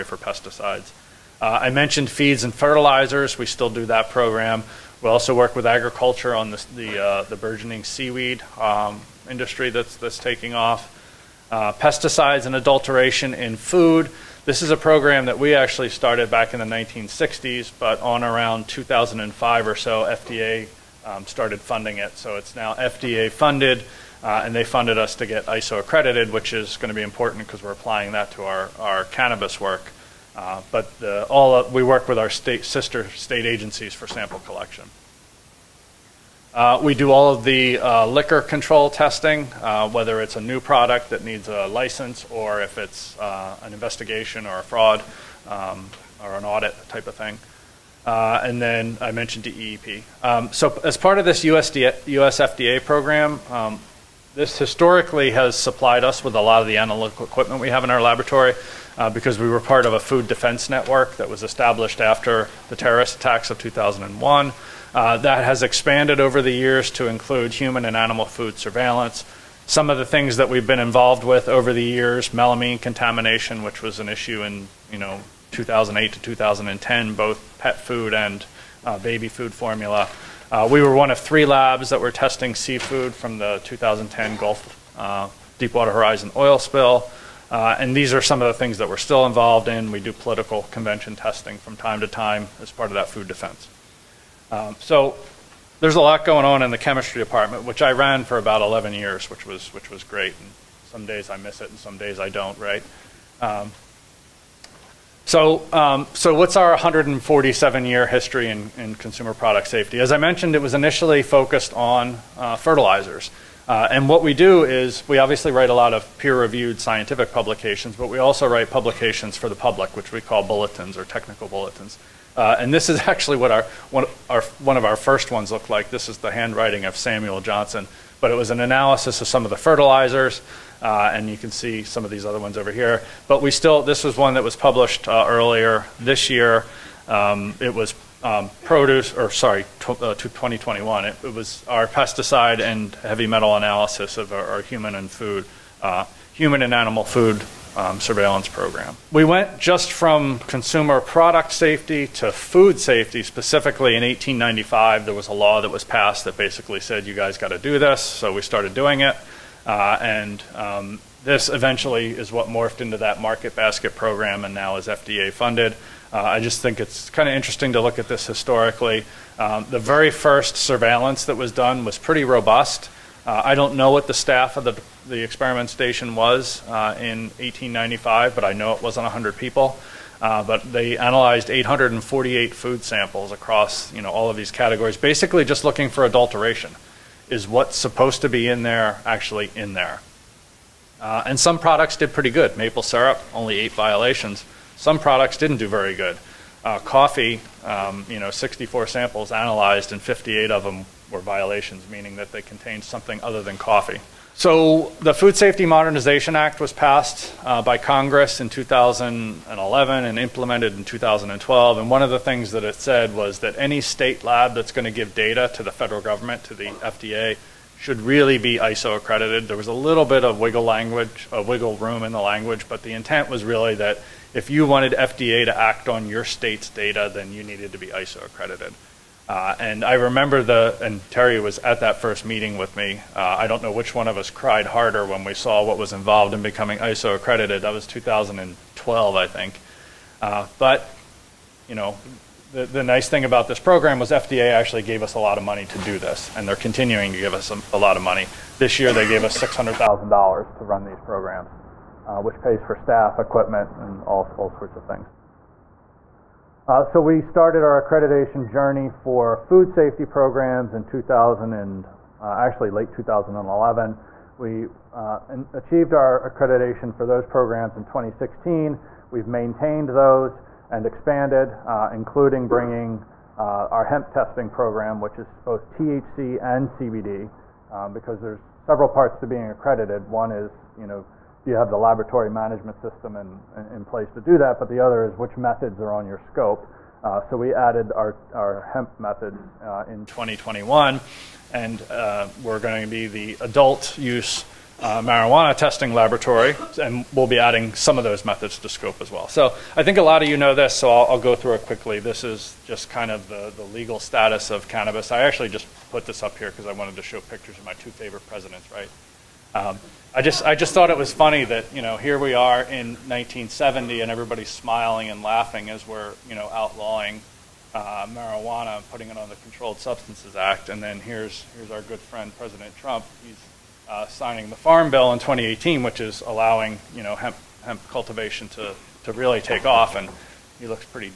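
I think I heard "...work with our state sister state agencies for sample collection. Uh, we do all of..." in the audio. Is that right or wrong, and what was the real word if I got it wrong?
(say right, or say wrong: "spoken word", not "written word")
right.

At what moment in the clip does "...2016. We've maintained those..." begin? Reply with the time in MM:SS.
04:27.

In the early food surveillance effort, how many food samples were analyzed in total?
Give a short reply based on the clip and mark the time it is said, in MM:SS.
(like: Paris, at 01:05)
848, at 03:01.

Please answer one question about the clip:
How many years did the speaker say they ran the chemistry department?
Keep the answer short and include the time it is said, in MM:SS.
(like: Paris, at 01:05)
11, at 01:38.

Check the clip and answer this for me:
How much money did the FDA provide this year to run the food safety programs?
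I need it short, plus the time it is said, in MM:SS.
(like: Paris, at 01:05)
$600,000, at 04:09.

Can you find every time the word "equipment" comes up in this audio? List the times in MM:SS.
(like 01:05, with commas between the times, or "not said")
00:57, 04:13.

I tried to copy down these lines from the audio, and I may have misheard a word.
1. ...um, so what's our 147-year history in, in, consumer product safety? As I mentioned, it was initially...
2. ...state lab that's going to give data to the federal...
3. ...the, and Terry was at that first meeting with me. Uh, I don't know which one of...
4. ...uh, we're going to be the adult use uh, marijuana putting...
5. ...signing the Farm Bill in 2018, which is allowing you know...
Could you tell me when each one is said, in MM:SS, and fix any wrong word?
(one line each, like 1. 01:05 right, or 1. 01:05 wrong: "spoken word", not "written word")
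1. 01:45 right
2. 03:33 right
3. 03:50 right
4. 04:51 wrong: "testing", not "putting"
5. 05:24 right.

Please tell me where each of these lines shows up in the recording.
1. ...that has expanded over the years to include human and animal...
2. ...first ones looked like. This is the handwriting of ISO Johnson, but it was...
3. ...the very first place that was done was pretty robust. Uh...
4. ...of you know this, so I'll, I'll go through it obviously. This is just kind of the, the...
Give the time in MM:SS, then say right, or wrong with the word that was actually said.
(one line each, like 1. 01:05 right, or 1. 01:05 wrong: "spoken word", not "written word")
1. 01:05 right
2. 02:04 wrong: "Samuel", not "ISO"
3. 02:49 wrong: "surveillance", not "place"
4. 05:00 wrong: "quickly", not "obviously".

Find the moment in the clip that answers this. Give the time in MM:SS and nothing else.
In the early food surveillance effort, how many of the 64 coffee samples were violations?
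03:20.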